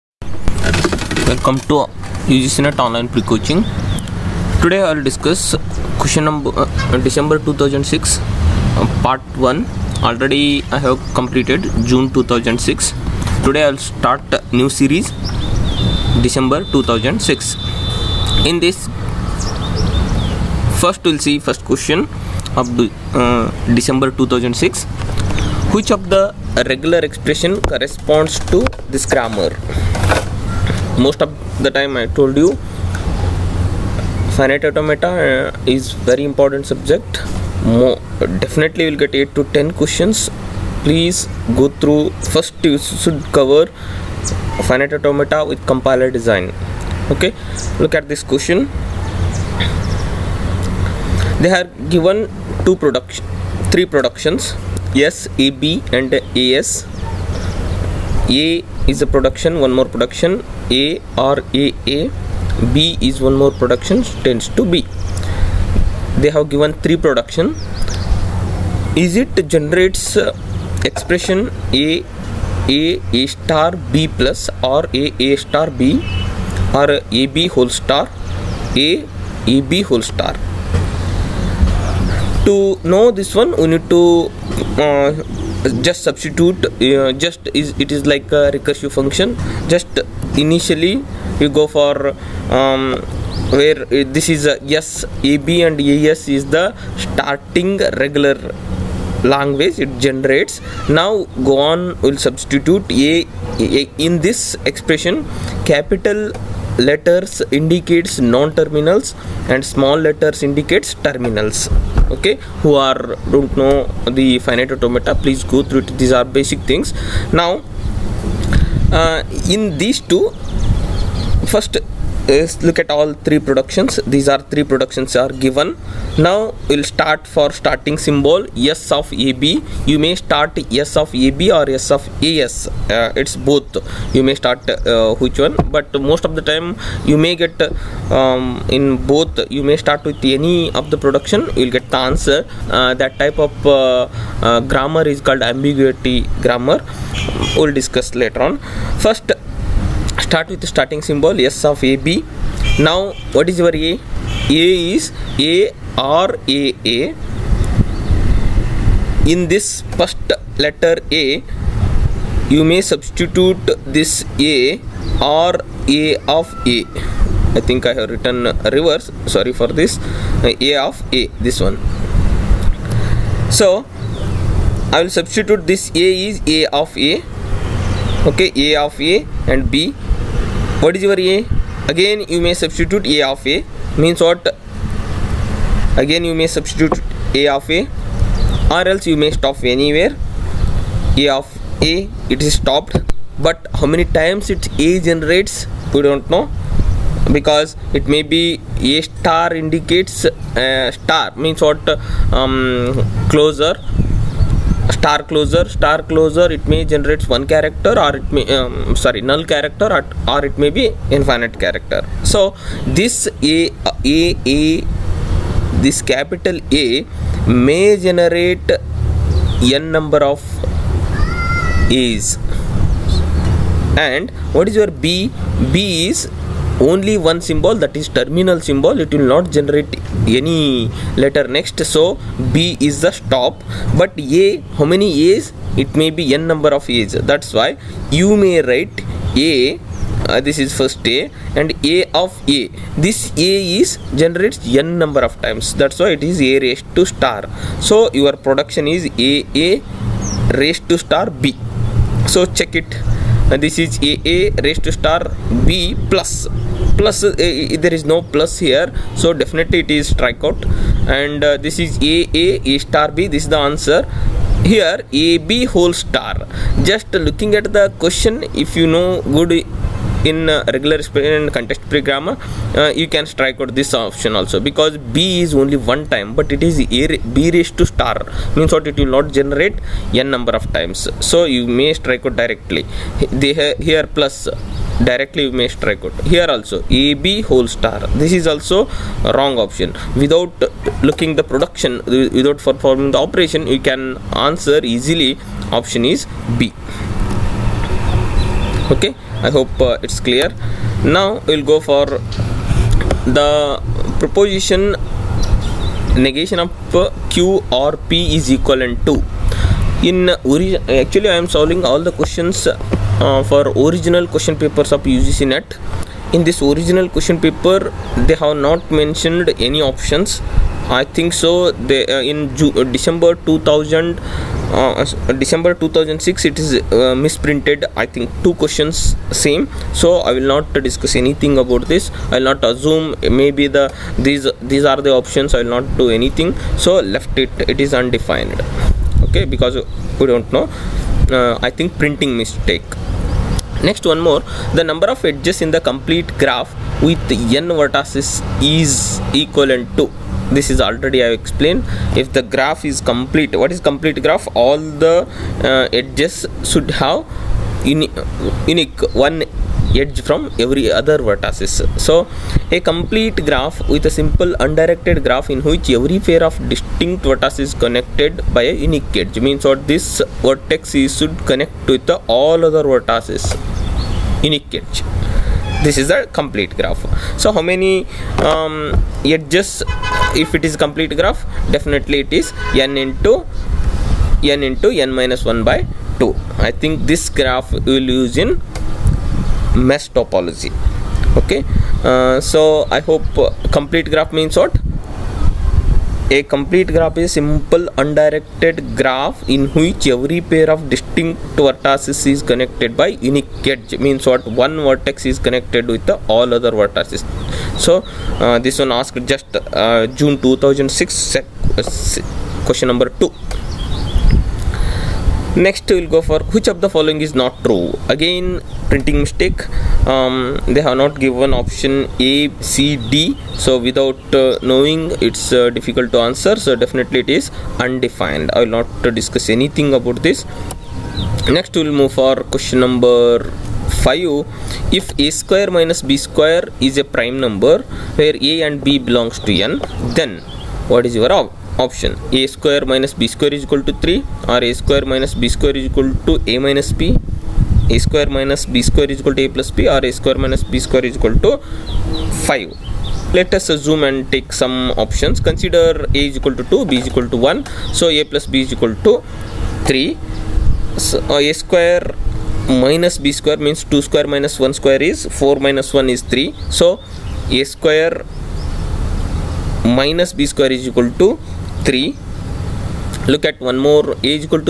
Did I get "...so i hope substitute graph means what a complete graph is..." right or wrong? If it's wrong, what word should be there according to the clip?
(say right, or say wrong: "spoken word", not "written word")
wrong: "complete", not "substitute".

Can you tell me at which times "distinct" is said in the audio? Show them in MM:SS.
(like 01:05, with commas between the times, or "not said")
06:06, 06:40.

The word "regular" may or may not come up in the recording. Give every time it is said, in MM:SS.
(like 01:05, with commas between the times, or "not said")
00:26, 01:38, 04:30.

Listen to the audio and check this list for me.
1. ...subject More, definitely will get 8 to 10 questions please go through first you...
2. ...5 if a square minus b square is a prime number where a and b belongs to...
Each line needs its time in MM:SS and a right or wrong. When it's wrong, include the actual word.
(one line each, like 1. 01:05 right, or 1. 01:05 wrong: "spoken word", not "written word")
1. 00:36 right
2. 07:14 right.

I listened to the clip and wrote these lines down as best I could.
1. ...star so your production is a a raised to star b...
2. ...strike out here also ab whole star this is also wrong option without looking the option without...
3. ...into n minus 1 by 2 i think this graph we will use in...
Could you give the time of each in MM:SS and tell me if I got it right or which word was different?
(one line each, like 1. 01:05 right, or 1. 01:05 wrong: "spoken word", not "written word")
1. 04:07 right
2. 04:45 wrong: "production", not "option"
3. 06:24 right.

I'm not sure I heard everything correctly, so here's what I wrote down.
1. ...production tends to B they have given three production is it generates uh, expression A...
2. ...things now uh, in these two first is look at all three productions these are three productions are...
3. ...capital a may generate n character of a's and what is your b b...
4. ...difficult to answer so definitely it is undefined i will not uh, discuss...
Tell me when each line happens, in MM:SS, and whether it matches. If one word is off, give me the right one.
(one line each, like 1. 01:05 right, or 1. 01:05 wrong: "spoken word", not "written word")
1. 01:03 right
2. 01:56 right
3. 03:36 wrong: "number", not "character"
4. 07:05 right.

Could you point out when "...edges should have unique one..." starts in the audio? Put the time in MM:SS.
05:55.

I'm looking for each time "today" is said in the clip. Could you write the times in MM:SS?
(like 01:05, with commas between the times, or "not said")
00:04, 00:13.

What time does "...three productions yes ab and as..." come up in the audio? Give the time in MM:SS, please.
00:53.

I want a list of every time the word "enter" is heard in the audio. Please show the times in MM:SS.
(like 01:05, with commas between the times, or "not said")
not said.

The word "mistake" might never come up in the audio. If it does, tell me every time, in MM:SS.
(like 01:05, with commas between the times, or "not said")
05:42, 06:59.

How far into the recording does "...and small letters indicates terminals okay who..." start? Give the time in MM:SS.
01:49.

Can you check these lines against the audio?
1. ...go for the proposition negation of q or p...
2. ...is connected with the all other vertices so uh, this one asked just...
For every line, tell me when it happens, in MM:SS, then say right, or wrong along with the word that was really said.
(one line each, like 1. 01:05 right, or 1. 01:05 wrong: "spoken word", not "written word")
1. 05:01 right
2. 06:45 right.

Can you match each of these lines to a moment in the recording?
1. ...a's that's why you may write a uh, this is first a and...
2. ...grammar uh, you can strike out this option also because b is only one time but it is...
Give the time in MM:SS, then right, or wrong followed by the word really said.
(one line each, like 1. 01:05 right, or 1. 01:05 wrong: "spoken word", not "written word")
1. 03:56 right
2. 04:32 right.